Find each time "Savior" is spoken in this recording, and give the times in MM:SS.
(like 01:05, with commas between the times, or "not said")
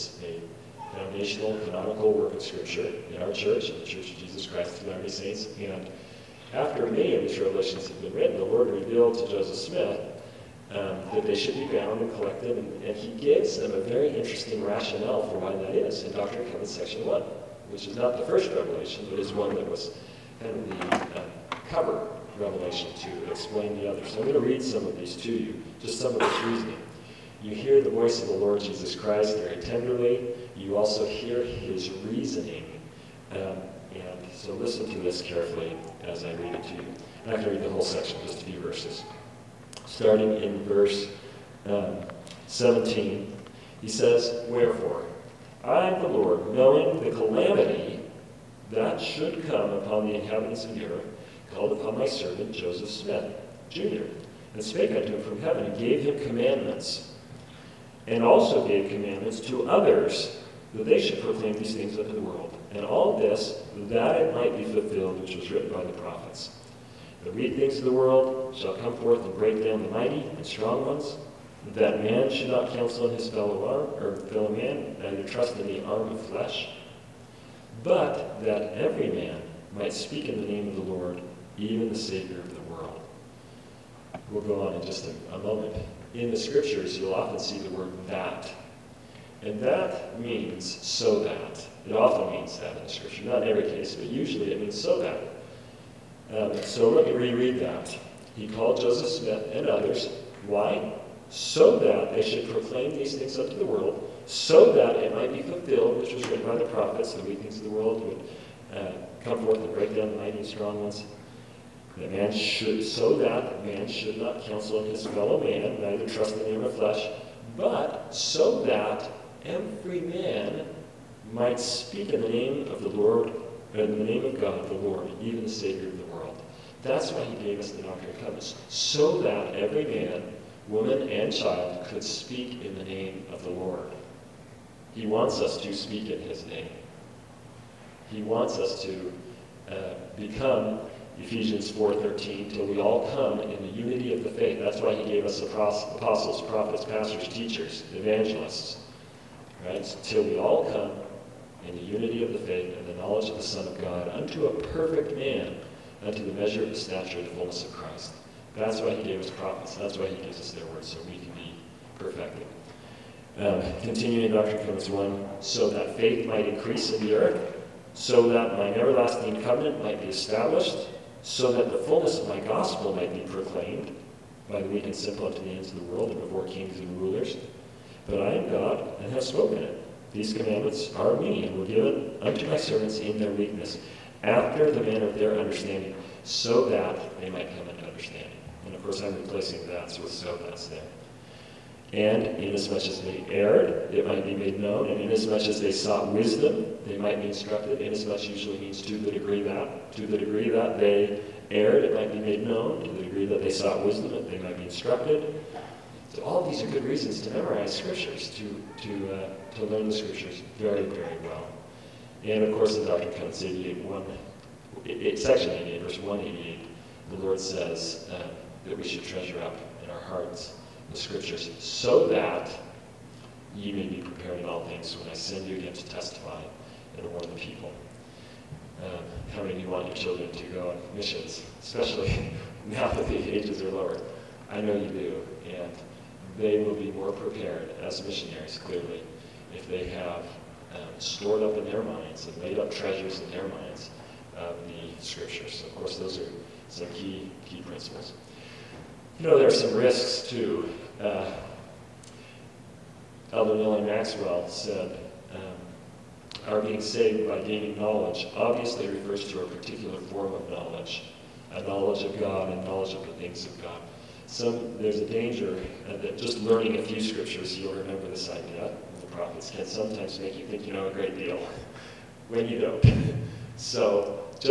01:21, 02:05.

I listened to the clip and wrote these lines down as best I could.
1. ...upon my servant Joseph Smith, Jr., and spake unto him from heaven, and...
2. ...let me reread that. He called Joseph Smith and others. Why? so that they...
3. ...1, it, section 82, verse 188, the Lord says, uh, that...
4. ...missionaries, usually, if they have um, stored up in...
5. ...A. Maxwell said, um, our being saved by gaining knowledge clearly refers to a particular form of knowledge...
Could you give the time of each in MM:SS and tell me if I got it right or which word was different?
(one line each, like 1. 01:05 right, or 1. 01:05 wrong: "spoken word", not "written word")
1. 00:51 right
2. 01:36 right
3. 03:33 wrong: "88", not "82"
4. 03:58 wrong: "clearly", not "usually"
5. 04:13 wrong: "obviously", not "clearly".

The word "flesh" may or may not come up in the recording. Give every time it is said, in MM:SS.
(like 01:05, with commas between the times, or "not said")
01:16, 01:56.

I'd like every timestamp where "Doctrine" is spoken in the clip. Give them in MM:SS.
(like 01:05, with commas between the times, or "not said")
00:16, 02:07.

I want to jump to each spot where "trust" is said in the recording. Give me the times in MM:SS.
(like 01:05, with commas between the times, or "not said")
01:15, 01:56.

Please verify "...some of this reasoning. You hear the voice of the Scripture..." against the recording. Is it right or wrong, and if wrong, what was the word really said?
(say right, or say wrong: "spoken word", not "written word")
wrong: "Lord", not "Scripture".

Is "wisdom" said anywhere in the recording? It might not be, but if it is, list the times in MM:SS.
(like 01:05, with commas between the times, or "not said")
03:16, 03:23.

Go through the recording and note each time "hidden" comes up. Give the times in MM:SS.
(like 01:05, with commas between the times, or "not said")
not said.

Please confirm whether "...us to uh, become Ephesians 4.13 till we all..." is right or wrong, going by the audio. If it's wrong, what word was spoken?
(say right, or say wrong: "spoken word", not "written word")
right.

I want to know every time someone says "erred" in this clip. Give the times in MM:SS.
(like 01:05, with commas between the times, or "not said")
03:13, 03:21.